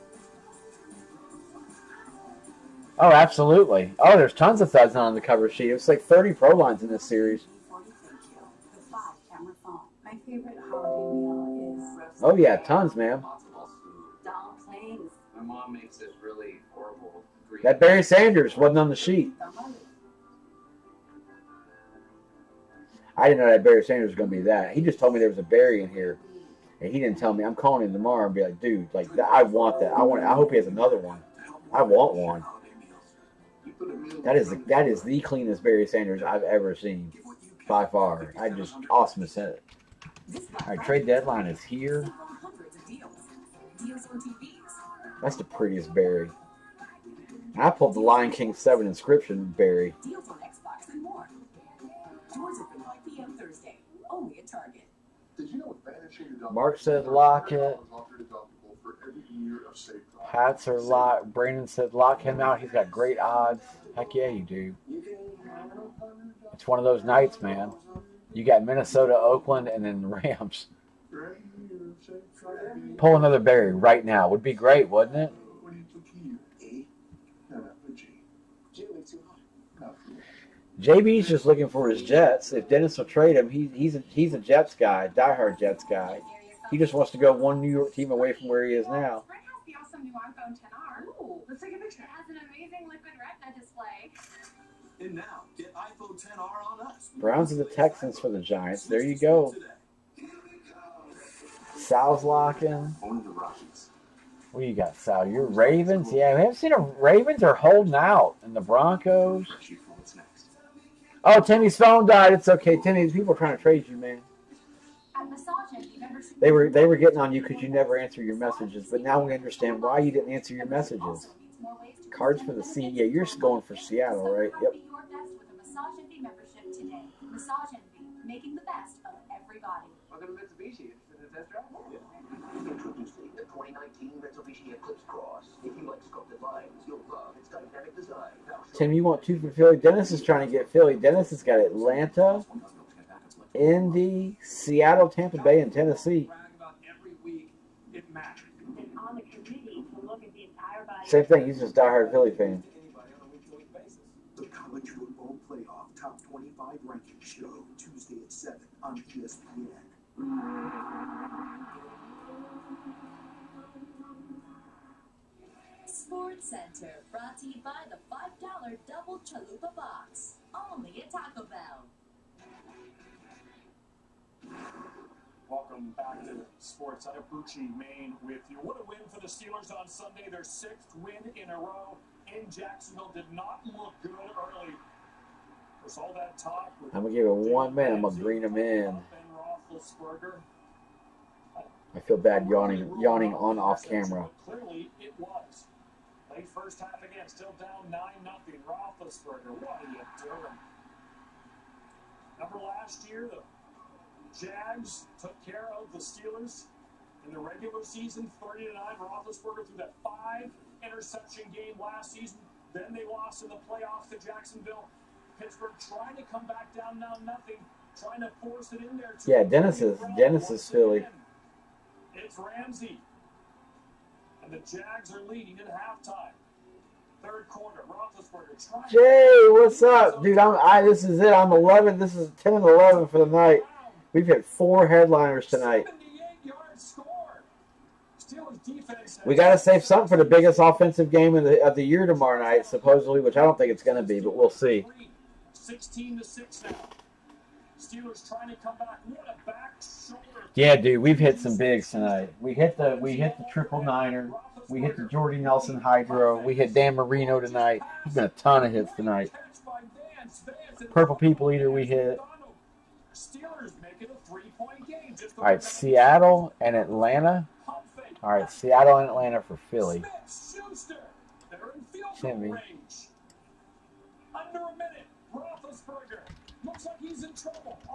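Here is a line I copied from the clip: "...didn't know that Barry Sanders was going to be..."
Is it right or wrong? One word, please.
right.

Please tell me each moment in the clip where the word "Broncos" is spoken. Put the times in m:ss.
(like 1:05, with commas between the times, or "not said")
1:48.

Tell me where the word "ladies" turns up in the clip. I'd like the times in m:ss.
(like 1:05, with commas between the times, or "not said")
not said.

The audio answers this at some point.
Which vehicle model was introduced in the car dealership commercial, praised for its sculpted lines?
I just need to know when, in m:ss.
2:13.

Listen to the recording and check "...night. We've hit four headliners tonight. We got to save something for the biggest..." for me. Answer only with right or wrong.
right.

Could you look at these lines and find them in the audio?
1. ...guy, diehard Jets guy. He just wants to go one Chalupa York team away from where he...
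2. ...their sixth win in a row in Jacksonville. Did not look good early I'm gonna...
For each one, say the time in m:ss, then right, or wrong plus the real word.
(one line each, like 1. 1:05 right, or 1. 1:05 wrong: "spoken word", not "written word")
1. 1:24 wrong: "New", not "Chalupa"
2. 3:00 right.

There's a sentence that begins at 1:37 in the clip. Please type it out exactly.
Browns and the Texans for the Giants.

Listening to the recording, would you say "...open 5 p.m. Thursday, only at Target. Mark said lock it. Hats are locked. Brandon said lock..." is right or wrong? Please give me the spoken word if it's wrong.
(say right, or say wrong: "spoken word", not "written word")
right.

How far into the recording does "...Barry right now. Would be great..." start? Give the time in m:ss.
1:13.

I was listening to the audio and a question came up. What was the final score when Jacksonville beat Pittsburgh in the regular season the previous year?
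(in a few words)
30 to 9.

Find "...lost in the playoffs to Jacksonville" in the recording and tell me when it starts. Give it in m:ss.
3:33.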